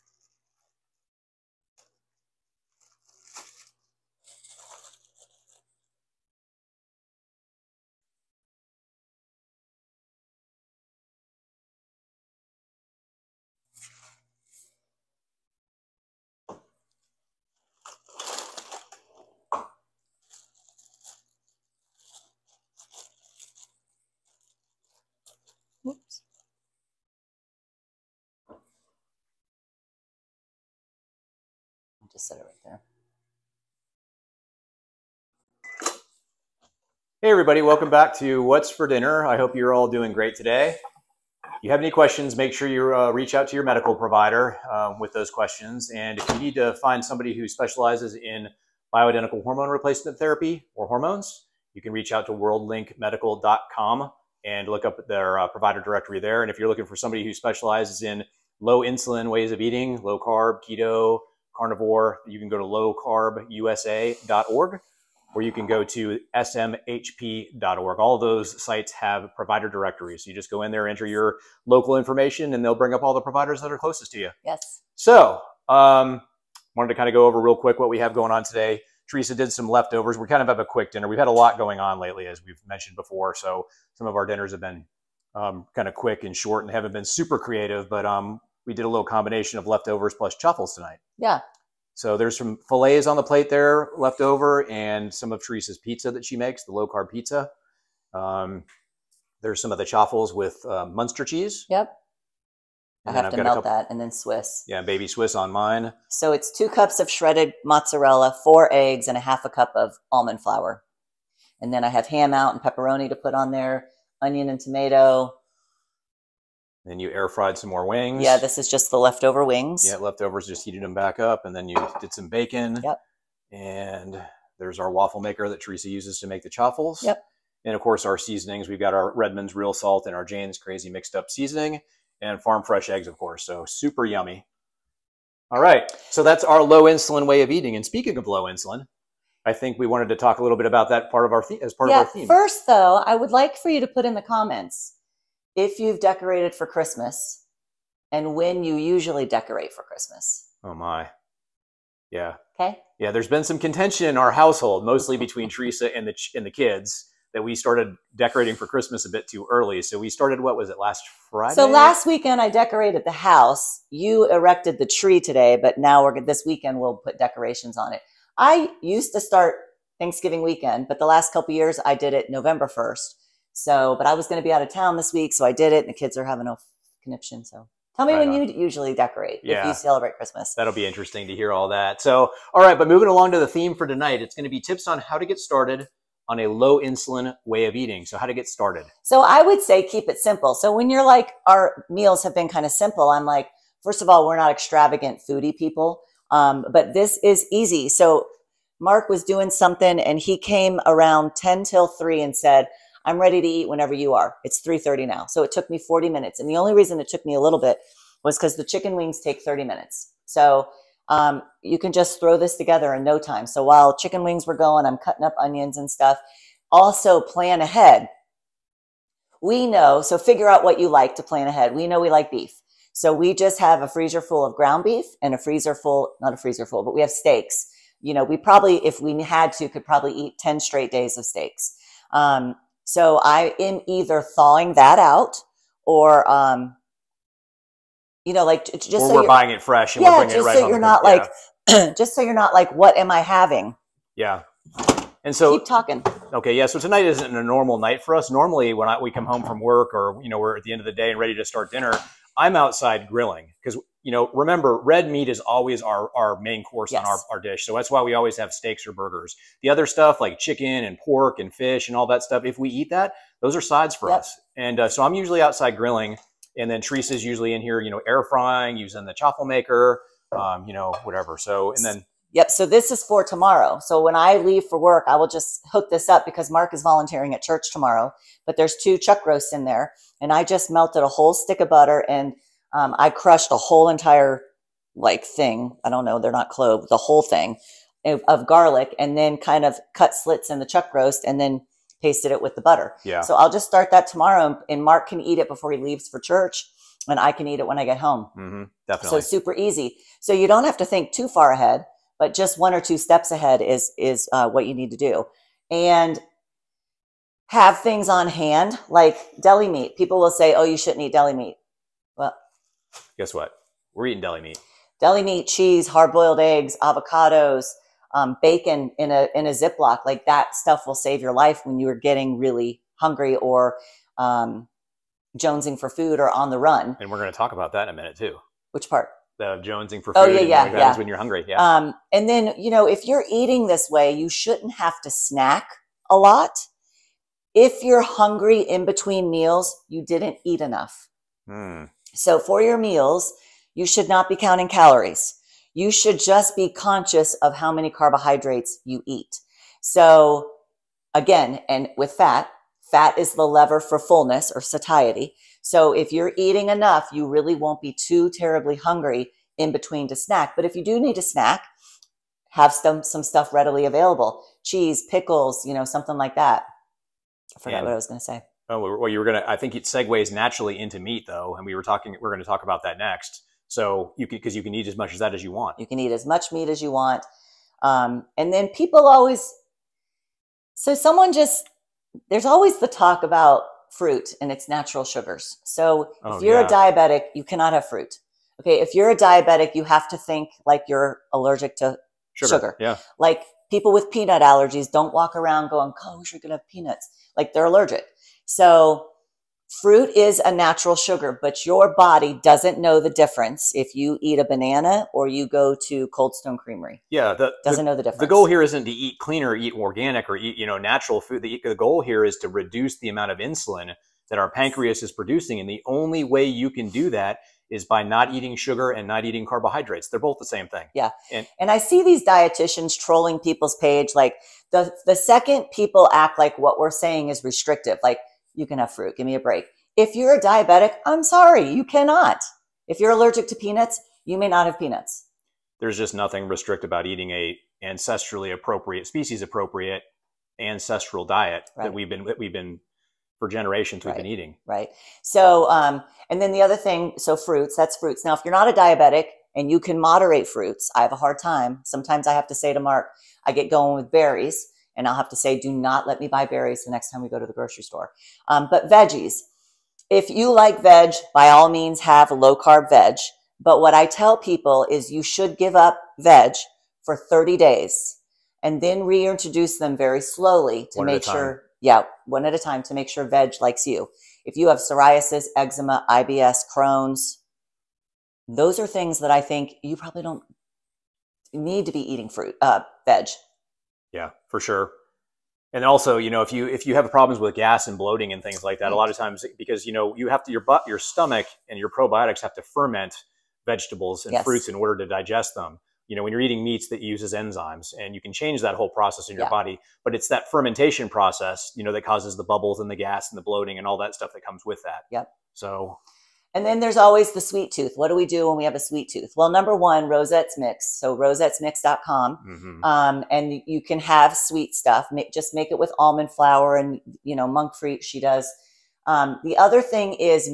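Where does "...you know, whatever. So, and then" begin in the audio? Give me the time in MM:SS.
04:30.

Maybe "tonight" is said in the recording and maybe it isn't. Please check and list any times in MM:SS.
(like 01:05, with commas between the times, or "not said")
01:30, 03:03, 04:06.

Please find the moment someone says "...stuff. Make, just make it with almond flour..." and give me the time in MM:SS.
08:34.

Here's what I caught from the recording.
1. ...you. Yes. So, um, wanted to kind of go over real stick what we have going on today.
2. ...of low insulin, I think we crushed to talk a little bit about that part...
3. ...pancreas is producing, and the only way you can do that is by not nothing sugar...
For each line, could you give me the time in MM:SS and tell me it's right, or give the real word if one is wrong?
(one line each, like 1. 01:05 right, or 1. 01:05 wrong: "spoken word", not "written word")
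1. 01:14 wrong: "quick", not "stick"
2. 02:18 wrong: "wanted", not "crushed"
3. 06:54 wrong: "eating", not "nothing".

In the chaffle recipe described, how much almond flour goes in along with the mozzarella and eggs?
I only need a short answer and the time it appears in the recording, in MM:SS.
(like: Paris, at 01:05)
half a cup, at 01:49.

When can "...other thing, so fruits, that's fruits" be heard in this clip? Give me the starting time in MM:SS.
07:26.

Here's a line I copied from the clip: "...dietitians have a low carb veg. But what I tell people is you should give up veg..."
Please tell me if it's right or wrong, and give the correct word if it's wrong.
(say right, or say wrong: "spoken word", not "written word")
wrong: "means", not "dietitians".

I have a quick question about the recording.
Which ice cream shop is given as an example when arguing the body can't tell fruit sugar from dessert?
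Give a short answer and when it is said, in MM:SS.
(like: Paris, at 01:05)
Cold Stone Creamery, at 06:46.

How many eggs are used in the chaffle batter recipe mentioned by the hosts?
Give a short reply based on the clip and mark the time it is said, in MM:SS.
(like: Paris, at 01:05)
4, at 01:48.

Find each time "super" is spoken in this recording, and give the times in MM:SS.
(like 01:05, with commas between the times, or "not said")
01:27, 02:13, 04:59.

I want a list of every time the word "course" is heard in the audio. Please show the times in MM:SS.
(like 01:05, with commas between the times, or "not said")
02:07, 02:13, 04:16.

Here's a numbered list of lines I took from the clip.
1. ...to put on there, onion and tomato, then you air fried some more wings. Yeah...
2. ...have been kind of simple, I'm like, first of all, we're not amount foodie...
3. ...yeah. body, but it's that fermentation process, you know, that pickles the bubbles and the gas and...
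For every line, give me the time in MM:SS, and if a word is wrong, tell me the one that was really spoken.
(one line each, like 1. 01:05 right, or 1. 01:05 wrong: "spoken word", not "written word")
1. 01:53 right
2. 03:12 wrong: "extravagant", not "amount"
3. 08:19 wrong: "causes", not "pickles".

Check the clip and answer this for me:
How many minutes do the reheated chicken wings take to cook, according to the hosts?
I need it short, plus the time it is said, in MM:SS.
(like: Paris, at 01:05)
30, at 03:29.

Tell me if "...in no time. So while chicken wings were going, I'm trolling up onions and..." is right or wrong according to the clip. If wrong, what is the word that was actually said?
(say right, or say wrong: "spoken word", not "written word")
wrong: "cutting", not "trolling".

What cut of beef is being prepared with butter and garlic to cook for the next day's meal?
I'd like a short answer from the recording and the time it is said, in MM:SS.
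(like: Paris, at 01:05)
chuck roast, at 04:38.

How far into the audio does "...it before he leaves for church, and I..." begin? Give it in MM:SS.
04:55.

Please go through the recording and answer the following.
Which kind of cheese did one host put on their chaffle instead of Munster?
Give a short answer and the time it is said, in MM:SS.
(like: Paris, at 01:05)
baby Swiss, at 01:44.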